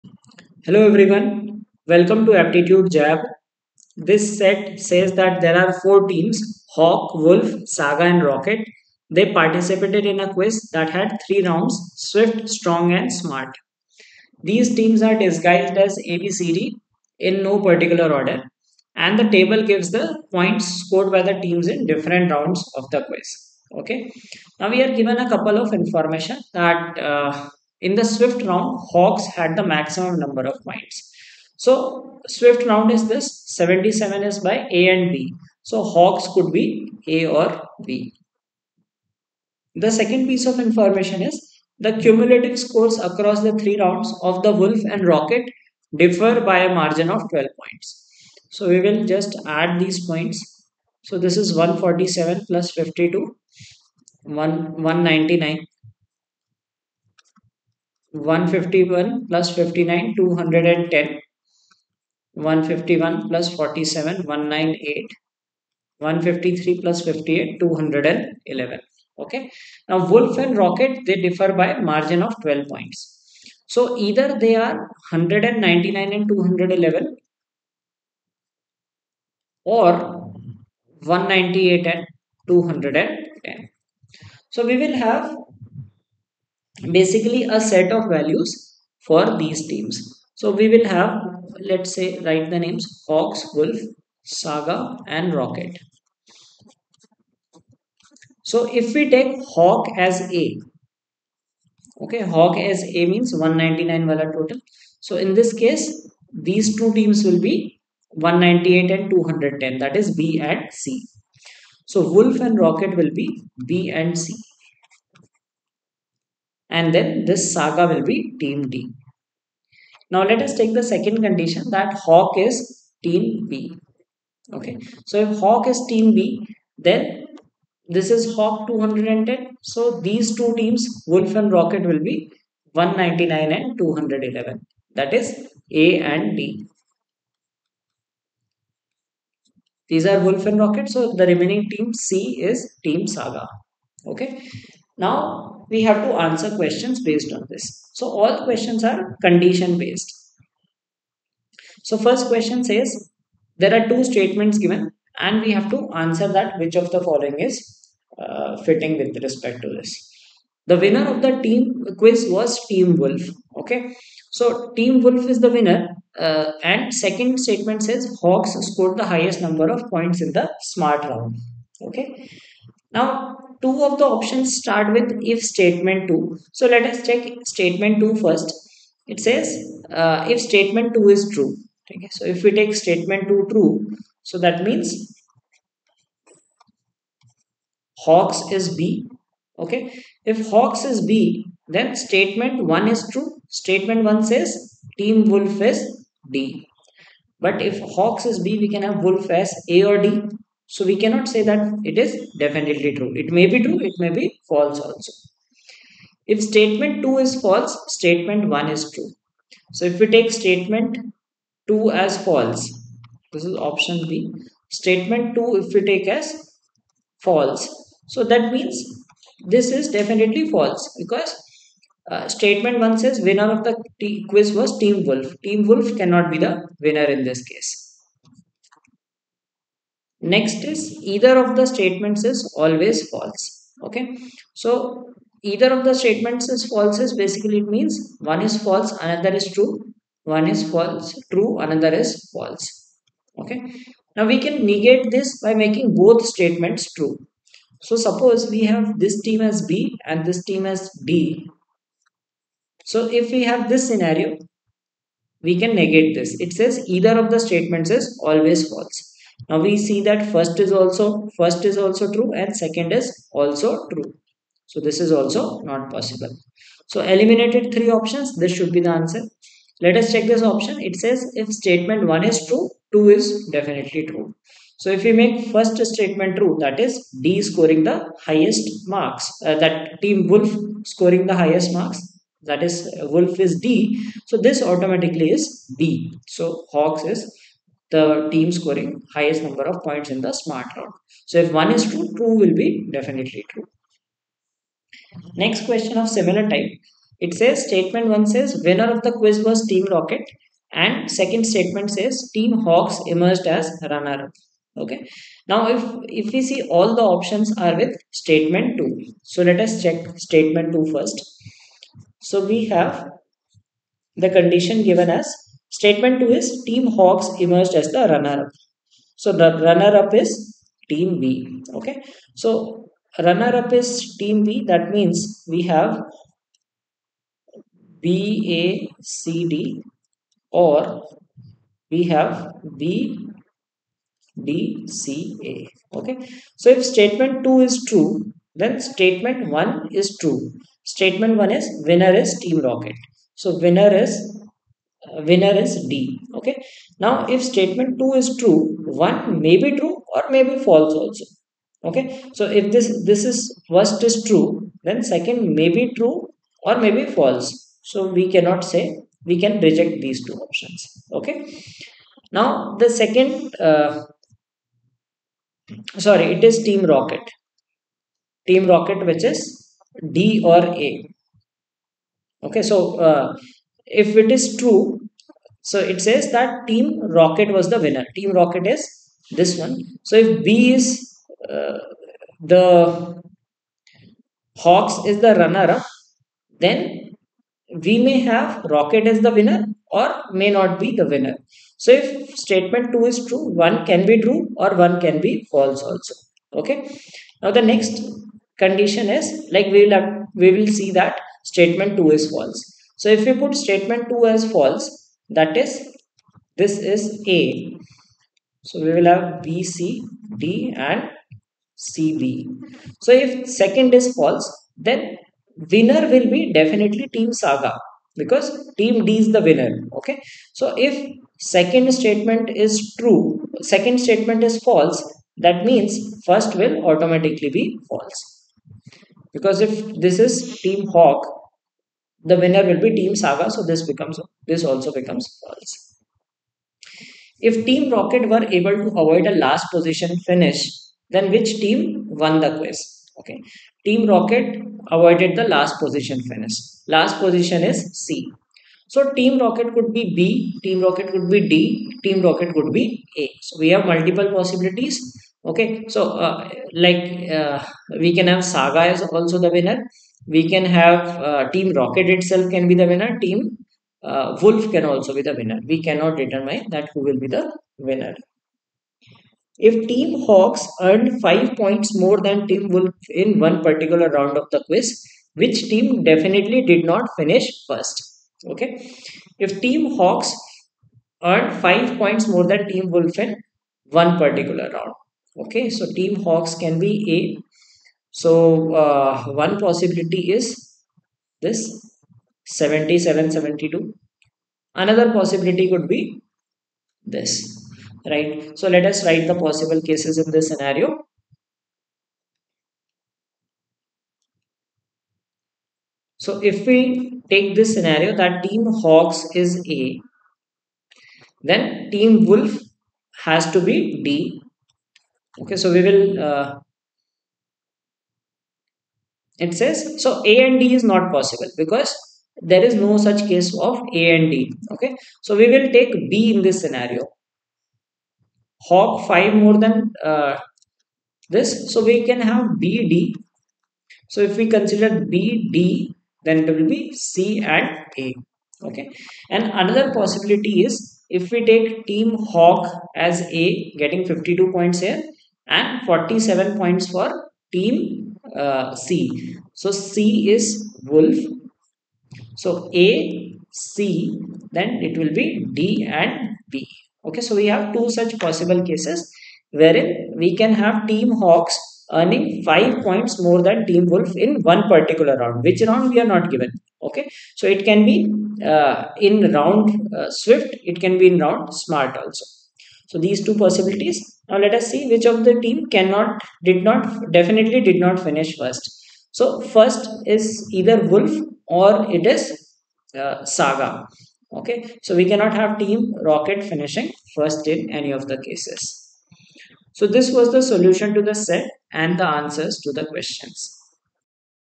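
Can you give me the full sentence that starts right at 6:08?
Team Rocket which is D or A.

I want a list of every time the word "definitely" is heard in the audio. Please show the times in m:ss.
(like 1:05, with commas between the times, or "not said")
3:22, 3:39, 4:33, 4:52, 6:56, 7:56, 9:37.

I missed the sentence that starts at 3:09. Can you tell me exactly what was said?
Okay, if Hawks is B, then statement 1 is true.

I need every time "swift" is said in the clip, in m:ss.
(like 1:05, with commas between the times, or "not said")
0:11, 0:28, 0:32, 9:30.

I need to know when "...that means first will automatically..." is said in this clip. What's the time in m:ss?
7:05.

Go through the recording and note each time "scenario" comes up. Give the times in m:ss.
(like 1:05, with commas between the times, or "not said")
4:13, 8:20, 8:27, 8:46.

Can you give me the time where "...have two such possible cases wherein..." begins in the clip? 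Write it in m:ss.
9:17.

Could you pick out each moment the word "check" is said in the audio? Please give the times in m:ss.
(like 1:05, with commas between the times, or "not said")
2:57, 4:30, 5:09.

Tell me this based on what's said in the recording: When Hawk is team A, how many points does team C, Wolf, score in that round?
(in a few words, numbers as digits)
47.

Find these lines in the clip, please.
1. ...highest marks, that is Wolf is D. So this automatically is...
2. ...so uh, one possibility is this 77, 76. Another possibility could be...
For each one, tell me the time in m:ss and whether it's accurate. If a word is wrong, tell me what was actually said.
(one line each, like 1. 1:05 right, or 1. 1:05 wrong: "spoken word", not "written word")
1. 4:41 right
2. 8:08 wrong: "72", not "76".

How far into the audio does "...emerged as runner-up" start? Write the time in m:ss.
5:03.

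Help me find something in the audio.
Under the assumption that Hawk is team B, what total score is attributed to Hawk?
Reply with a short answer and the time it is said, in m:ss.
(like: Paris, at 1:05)
210, at 2:08.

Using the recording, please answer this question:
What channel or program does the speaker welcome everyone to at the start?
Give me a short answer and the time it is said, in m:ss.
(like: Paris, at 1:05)
Aptitude Jab, at 0:02.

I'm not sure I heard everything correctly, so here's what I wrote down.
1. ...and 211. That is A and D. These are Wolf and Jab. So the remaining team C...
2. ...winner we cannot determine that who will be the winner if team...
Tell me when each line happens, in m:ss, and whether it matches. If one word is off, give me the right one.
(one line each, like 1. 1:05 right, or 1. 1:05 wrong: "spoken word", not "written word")
1. 2:13 wrong: "Rocket", not "Jab"
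2. 7:45 right.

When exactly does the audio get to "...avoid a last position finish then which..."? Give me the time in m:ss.
7:19.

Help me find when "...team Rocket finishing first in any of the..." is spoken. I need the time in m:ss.
9:45.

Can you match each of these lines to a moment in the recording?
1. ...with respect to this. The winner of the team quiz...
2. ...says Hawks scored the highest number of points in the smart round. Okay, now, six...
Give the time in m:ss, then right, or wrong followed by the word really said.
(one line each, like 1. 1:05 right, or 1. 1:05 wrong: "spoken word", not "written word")
1. 2:38 right
2. 2:47 wrong: "two", not "six".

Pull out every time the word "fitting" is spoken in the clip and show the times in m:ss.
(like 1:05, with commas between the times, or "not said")
2:38.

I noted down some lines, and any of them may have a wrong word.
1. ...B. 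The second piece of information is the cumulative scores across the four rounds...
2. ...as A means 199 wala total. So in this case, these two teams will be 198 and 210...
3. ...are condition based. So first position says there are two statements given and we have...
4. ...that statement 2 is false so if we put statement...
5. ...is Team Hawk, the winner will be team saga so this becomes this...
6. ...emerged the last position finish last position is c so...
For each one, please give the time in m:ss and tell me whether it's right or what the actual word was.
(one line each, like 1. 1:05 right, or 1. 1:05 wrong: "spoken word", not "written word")
1. 0:37 wrong: "three", not "four"
2. 1:42 right
3. 2:28 wrong: "question", not "position"
4. 6:40 right
5. 7:10 right
6. 7:24 wrong: "avoided", not "emerged".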